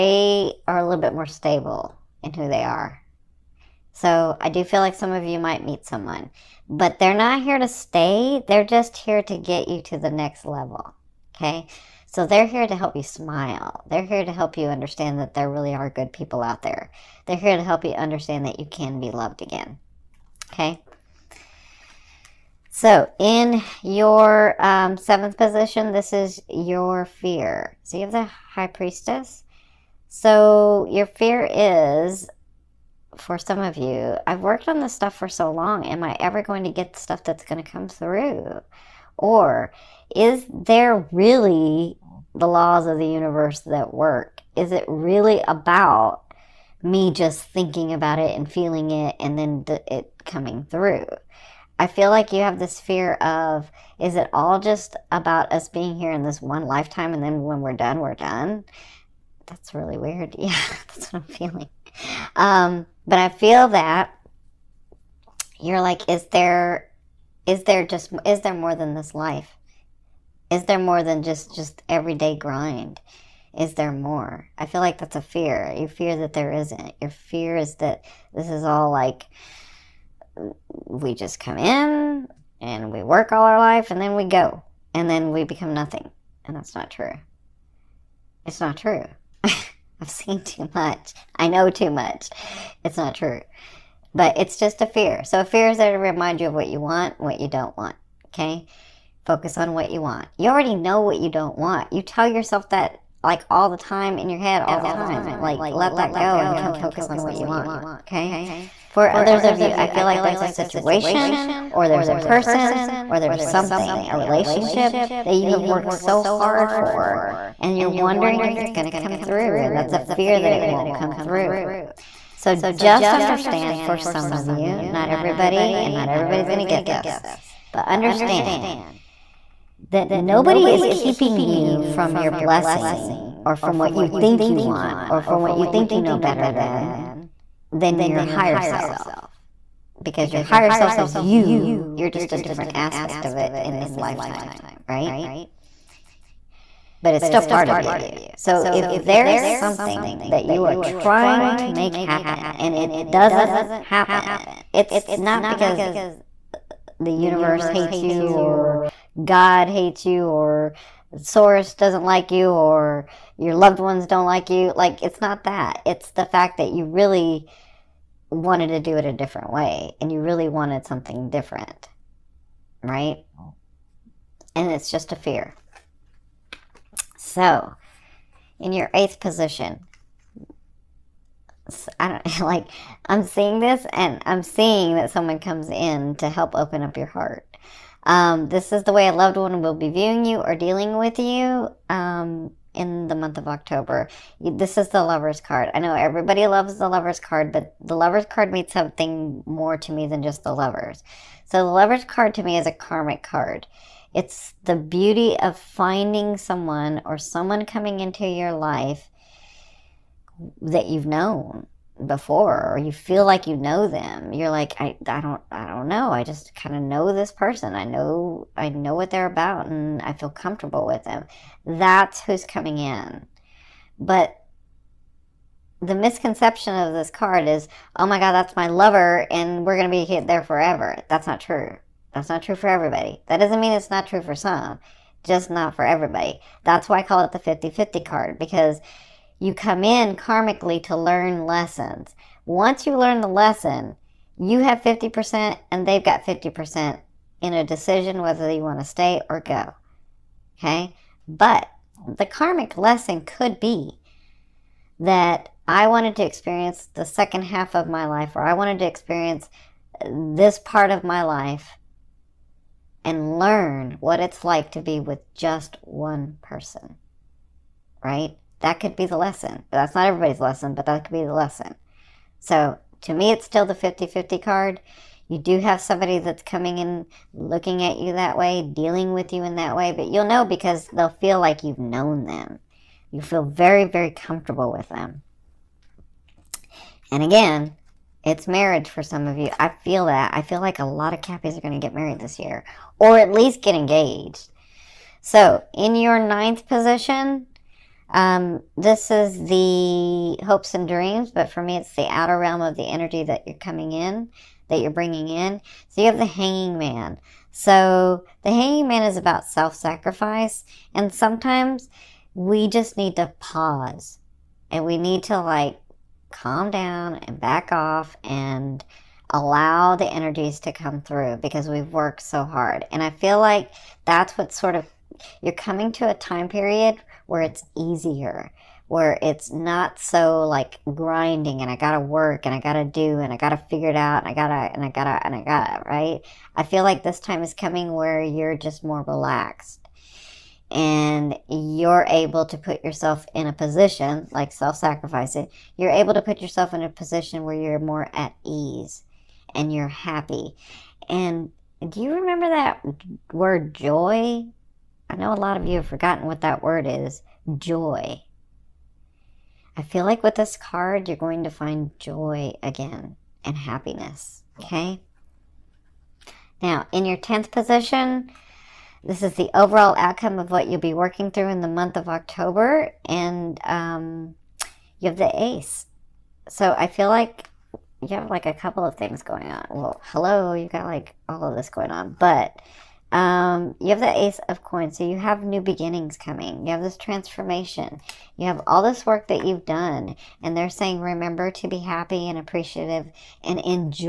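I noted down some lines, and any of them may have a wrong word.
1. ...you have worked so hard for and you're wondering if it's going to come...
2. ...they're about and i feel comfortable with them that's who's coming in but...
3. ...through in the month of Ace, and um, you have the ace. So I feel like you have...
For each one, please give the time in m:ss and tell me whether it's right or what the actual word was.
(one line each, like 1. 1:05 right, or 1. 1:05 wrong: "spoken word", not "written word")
1. 1:55 right
2. 3:39 right
3. 6:11 wrong: "October", not "Ace".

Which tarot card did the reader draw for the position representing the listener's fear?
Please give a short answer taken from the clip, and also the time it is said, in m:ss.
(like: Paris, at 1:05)
The High Priestess, at 0:28.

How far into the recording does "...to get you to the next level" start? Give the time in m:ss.
0:09.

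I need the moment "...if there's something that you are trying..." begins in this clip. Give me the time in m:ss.
2:28.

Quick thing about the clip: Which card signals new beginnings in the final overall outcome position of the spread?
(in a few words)
Ace of Coins.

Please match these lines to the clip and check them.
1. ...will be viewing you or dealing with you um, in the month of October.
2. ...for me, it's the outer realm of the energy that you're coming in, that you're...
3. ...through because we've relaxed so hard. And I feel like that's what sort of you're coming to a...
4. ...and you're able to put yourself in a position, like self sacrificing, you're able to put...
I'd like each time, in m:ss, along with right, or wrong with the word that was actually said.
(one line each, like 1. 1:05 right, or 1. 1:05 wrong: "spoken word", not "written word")
1. 3:09 right
2. 5:01 right
3. 5:21 wrong: "worked", not "relaxed"
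4. 5:40 right.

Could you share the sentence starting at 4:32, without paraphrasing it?
So to me, it's still the 50 50 card.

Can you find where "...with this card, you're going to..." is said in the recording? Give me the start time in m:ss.
6:00.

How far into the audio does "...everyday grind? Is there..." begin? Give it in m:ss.
1:11.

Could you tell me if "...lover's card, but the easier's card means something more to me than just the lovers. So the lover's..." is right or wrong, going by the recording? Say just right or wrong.
wrong.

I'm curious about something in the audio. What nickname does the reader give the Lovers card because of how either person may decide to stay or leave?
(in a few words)
The 50-50 card.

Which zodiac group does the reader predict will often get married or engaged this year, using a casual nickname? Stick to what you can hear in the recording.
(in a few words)
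Cappies.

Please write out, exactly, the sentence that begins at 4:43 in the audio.
You feel very, very comfortable with them.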